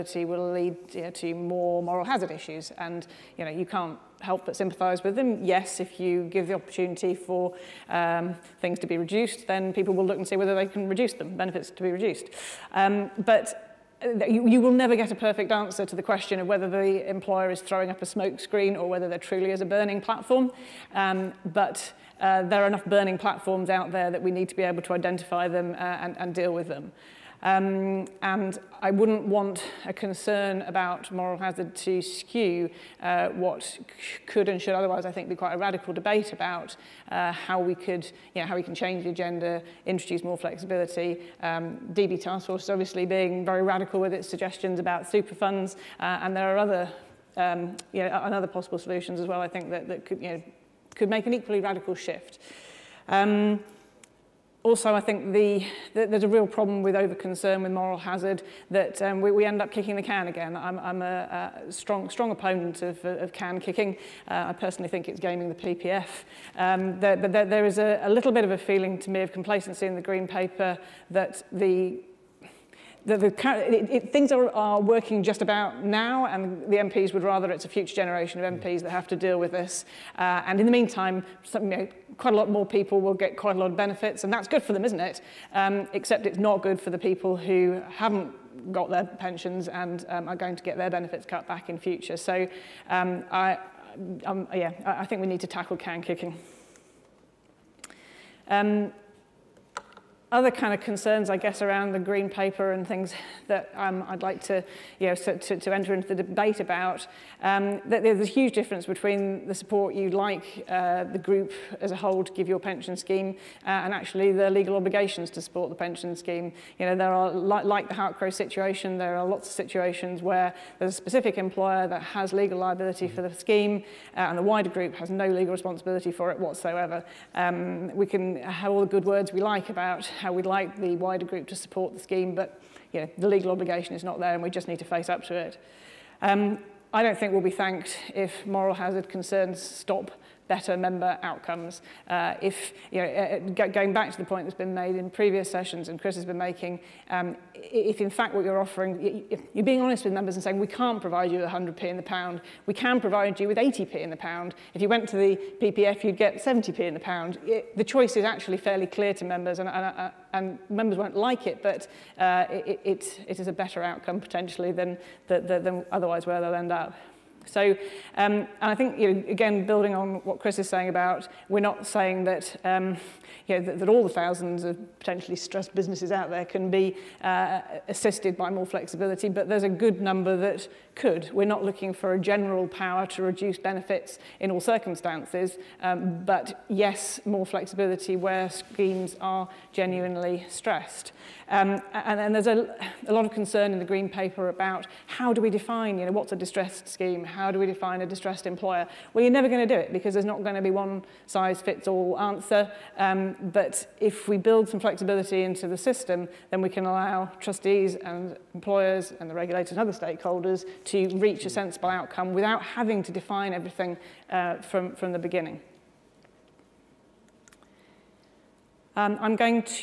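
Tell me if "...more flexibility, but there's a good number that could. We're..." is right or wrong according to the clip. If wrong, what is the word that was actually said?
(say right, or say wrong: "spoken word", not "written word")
right.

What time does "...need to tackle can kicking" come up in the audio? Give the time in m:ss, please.
1:35.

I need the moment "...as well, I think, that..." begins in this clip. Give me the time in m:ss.
0:49.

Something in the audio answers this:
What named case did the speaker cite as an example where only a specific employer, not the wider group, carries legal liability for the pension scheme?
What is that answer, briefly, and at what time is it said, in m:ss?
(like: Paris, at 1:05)
Halcrow, at 1:57.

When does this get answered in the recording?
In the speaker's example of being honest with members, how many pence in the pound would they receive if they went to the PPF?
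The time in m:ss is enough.
2:36.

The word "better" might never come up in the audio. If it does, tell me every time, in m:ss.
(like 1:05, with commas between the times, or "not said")
2:20, 2:43.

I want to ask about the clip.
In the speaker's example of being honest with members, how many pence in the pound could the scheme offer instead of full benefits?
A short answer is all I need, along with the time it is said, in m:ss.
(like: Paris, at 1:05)
80p, at 2:33.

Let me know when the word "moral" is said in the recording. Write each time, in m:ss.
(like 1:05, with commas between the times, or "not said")
0:01, 0:31, 0:57, 2:18.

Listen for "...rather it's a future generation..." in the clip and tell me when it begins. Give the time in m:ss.
1:17.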